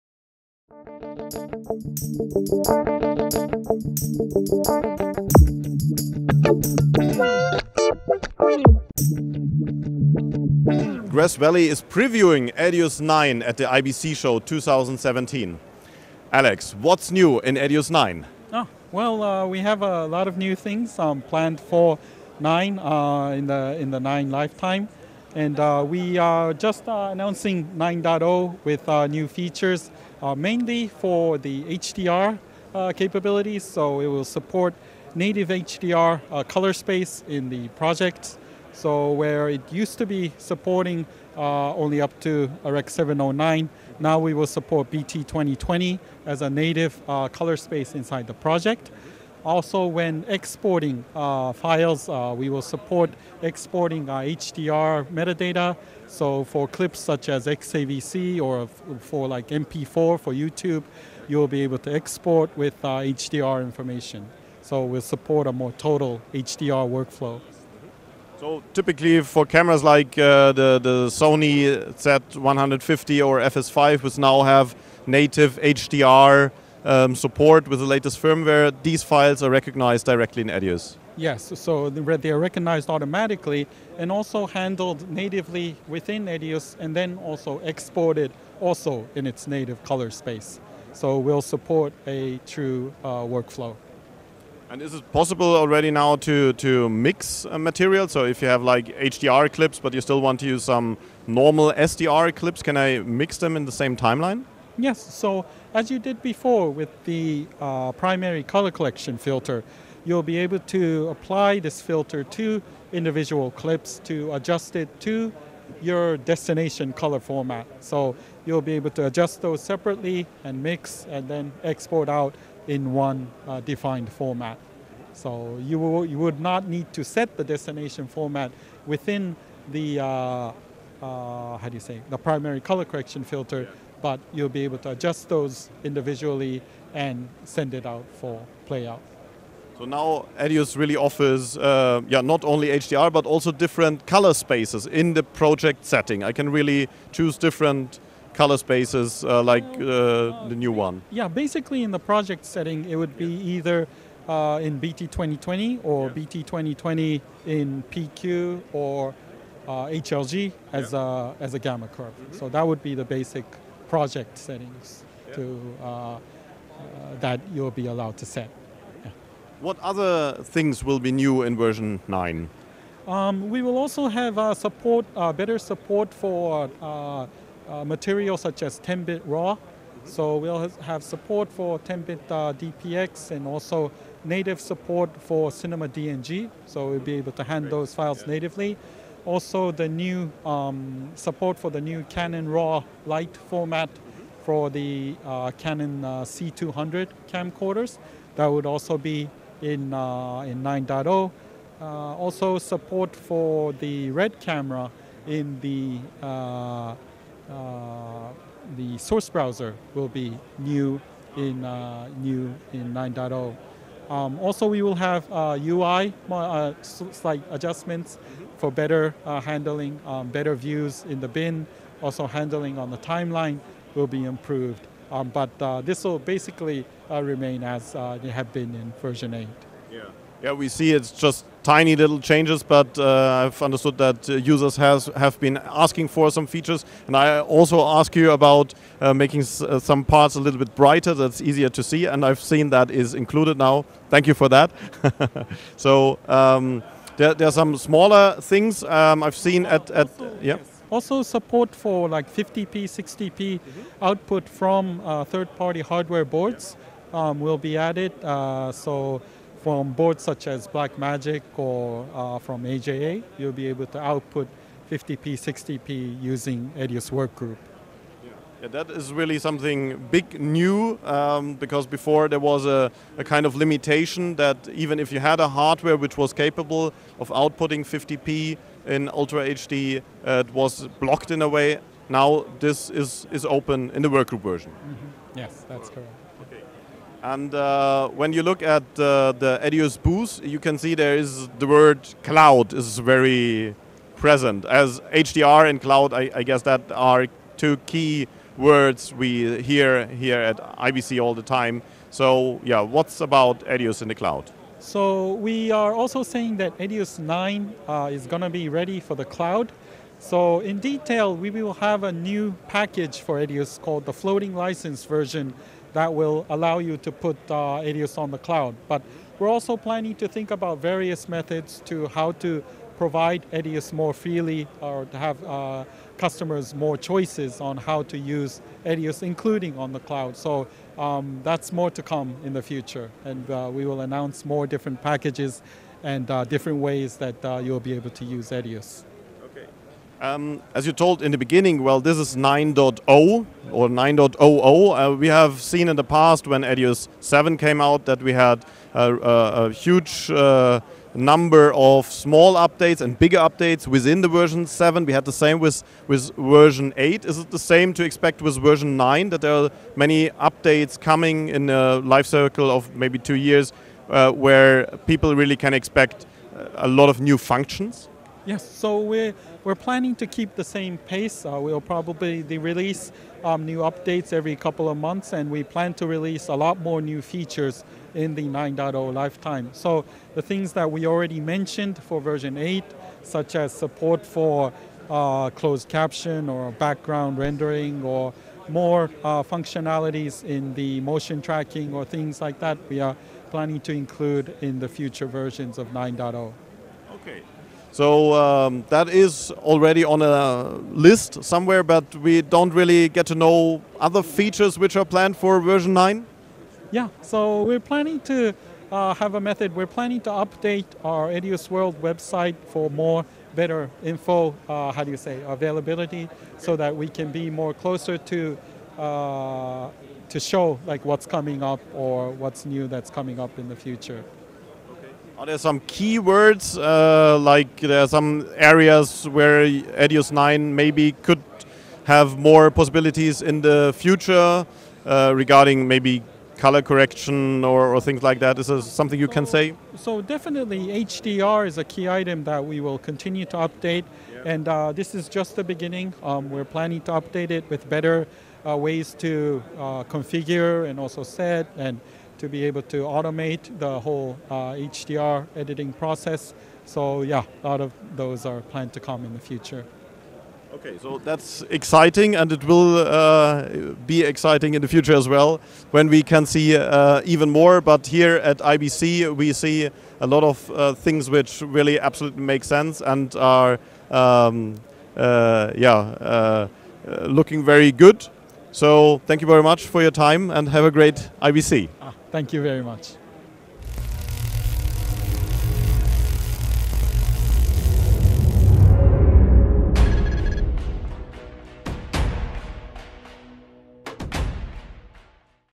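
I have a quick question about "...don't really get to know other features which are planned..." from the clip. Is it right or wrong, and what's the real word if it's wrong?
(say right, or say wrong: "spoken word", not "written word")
right.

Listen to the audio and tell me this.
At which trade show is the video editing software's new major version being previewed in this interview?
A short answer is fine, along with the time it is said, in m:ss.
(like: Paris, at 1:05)
IBC 2017, at 0:13.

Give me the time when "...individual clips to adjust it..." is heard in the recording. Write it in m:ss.
1:52.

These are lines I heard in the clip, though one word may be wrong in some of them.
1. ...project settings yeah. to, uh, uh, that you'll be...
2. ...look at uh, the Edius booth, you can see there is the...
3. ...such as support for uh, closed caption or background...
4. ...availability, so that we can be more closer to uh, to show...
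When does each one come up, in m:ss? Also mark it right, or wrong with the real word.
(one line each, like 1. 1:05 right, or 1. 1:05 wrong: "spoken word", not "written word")
1. 2:43 right
2. 4:48 right
3. 6:23 right
4. 6:55 right.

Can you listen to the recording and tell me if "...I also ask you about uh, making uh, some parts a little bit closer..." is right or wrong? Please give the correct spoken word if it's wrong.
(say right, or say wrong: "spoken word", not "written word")
wrong: "brighter", not "closer".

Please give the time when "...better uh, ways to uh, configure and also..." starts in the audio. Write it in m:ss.
7:27.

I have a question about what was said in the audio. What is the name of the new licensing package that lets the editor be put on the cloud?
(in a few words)
floating license.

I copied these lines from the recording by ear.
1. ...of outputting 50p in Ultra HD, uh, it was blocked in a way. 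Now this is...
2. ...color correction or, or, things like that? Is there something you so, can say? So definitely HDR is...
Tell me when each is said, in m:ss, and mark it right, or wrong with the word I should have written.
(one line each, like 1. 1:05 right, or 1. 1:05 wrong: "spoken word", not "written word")
1. 4:37 right
2. 7:16 right.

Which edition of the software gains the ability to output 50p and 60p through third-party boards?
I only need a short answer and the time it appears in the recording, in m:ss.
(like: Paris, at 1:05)
EDIUS Workgroup, at 4:26.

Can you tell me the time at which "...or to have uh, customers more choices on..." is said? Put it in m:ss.
5:24.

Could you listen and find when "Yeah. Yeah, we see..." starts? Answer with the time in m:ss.
3:49.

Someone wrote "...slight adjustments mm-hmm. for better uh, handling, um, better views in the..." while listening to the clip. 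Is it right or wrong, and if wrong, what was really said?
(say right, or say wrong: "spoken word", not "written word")
right.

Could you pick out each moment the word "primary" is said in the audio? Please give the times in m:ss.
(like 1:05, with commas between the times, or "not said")
1:47, 2:12.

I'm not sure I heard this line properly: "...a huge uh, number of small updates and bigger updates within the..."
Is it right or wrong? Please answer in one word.
right.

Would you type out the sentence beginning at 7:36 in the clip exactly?
So yeah, a lot of those are planned to come in the future.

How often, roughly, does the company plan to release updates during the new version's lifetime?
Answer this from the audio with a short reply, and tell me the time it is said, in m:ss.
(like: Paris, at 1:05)
every couple of months, at 6:14.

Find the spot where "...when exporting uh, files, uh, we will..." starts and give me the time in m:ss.
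0:49.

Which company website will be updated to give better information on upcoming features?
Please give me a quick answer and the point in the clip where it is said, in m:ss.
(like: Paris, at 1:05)
Edius World, at 6:51.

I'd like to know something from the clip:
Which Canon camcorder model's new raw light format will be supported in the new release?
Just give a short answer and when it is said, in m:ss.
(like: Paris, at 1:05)
C200, at 3:16.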